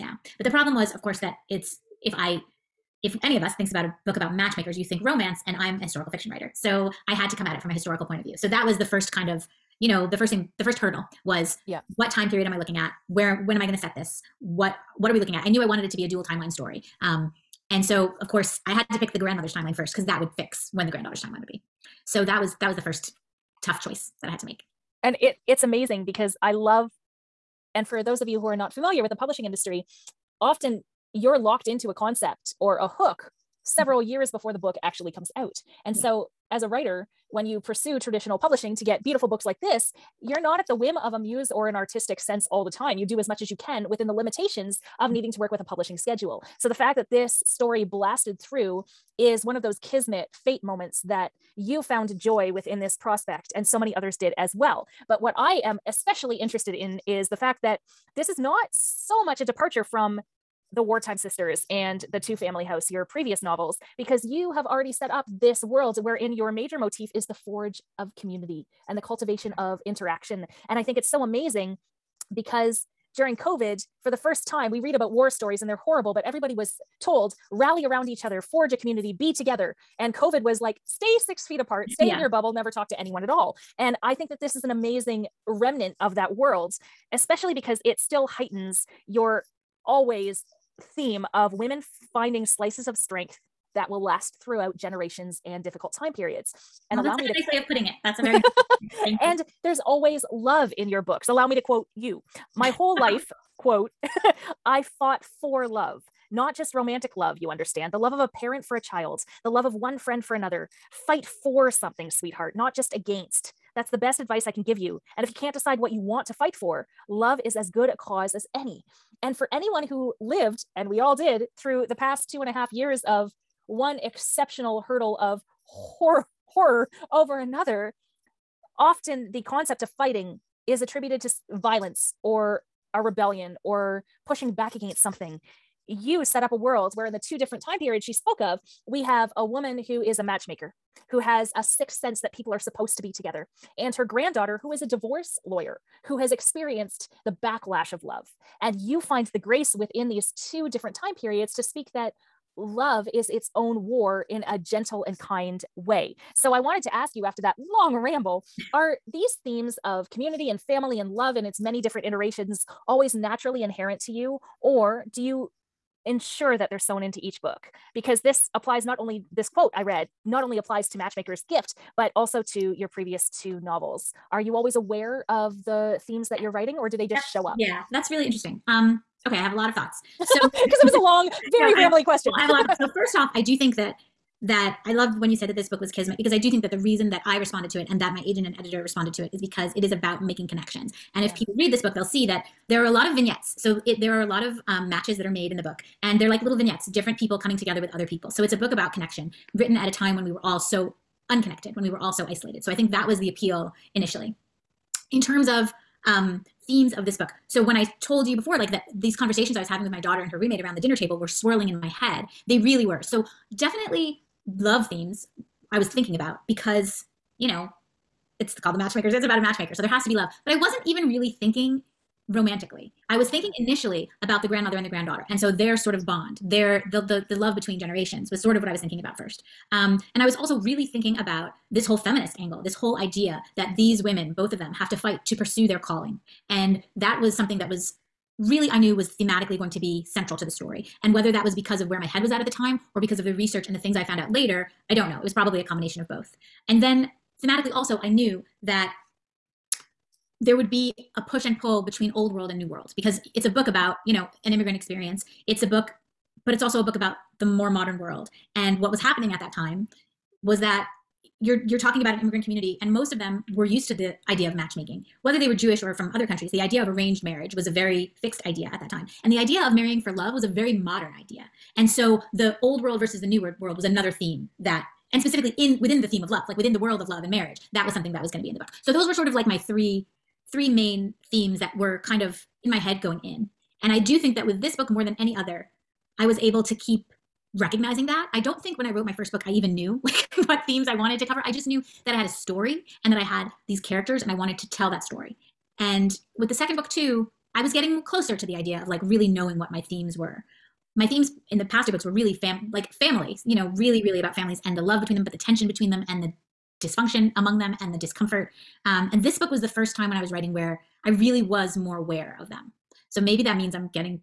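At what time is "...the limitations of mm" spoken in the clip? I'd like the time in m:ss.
0:44.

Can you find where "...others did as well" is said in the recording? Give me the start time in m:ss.
0:53.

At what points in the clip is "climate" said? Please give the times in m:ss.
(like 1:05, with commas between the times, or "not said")
not said.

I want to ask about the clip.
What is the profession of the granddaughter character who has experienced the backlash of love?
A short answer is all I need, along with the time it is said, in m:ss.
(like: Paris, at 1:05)
divorce lawyer, at 2:24.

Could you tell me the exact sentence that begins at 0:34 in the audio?
years before the book actually comes out.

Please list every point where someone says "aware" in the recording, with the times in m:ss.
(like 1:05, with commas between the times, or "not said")
2:54, 5:11.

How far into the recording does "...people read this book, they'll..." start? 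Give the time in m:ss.
3:11.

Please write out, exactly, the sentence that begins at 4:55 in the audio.
And with the second book, too, I was getting closer to the idea of like really knowing what my themes were.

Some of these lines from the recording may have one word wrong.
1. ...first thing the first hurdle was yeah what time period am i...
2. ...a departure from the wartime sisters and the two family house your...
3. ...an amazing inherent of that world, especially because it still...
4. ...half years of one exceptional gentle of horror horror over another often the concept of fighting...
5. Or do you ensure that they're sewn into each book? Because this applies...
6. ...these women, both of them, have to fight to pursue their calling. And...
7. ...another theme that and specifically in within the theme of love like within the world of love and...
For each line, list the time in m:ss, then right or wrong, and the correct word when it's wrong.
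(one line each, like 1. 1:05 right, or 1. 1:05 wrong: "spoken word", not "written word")
1. 0:10 right
2. 0:59 right
3. 1:24 wrong: "remnant", not "inherent"
4. 2:02 wrong: "hurdle", not "gentle"
5. 2:44 right
6. 3:53 right
7. 4:33 right.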